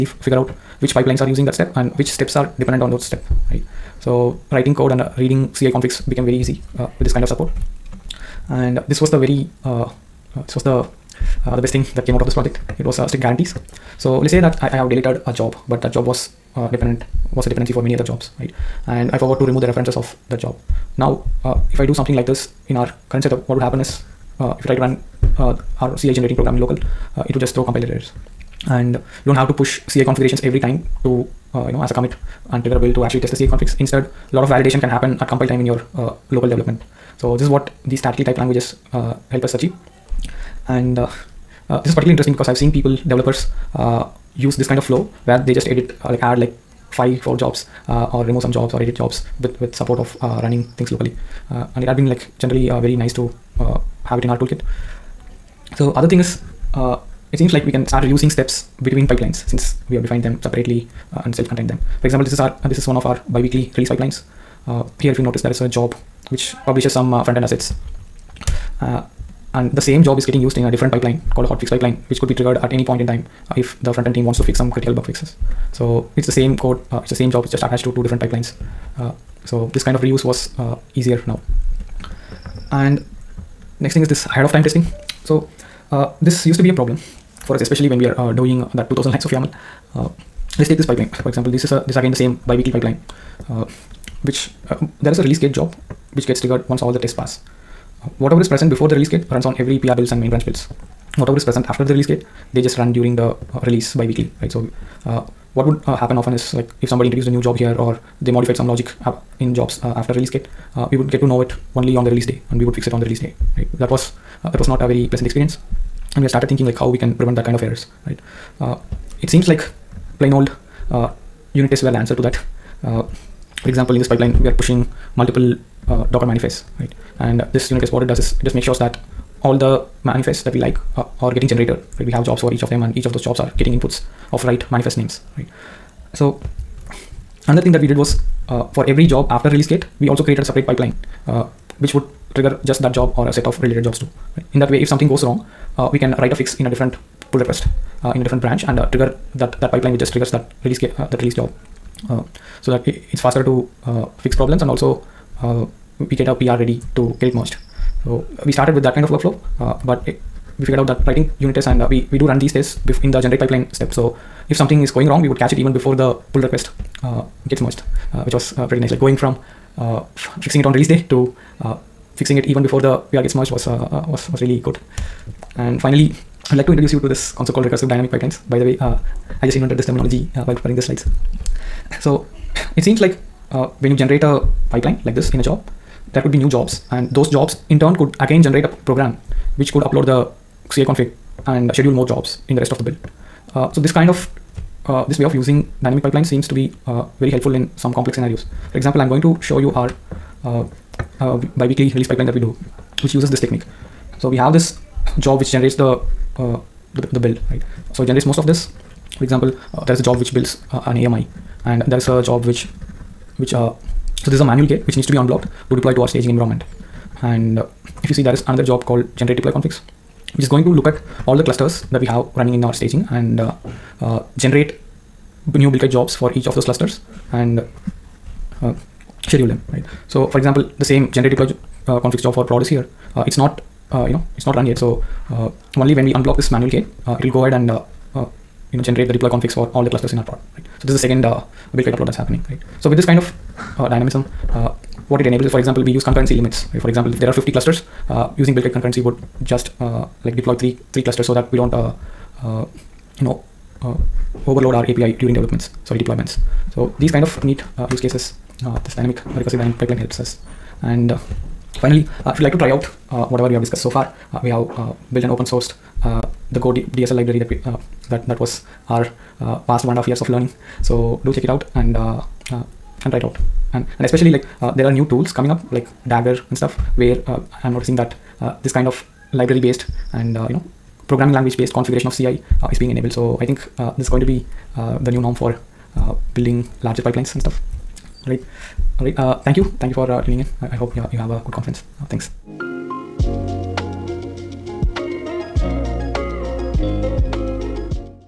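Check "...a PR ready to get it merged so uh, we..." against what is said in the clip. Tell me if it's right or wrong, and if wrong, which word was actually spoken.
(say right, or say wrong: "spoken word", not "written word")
right.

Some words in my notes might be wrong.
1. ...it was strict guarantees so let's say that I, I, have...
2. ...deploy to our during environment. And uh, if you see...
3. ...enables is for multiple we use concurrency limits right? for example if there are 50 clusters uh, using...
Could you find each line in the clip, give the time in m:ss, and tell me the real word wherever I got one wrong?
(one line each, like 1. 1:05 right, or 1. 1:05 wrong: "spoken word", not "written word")
1. 0:12 right
2. 3:35 wrong: "staging", not "during"
3. 4:05 wrong: "example", not "multiple".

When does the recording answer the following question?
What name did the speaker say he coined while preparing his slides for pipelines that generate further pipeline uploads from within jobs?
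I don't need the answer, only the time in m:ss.
2:57.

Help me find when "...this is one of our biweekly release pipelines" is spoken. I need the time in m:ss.
1:02.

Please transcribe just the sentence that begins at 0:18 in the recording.
And I forgot to remove the references of that job.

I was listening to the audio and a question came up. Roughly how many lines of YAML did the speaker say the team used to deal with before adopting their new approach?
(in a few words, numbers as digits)
2000.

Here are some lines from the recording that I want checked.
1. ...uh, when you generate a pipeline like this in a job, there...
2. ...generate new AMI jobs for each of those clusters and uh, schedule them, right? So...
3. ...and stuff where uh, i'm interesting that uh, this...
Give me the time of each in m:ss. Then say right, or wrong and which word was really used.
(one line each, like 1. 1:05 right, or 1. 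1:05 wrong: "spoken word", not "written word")
1. 3:03 right
2. 3:44 wrong: "Buildkite", not "AMI"
3. 4:36 wrong: "noticing", not "interesting".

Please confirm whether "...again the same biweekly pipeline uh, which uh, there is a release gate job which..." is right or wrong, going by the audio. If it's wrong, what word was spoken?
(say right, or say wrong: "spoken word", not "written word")
right.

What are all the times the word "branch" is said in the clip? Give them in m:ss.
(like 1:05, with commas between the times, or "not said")
1:40, 2:28.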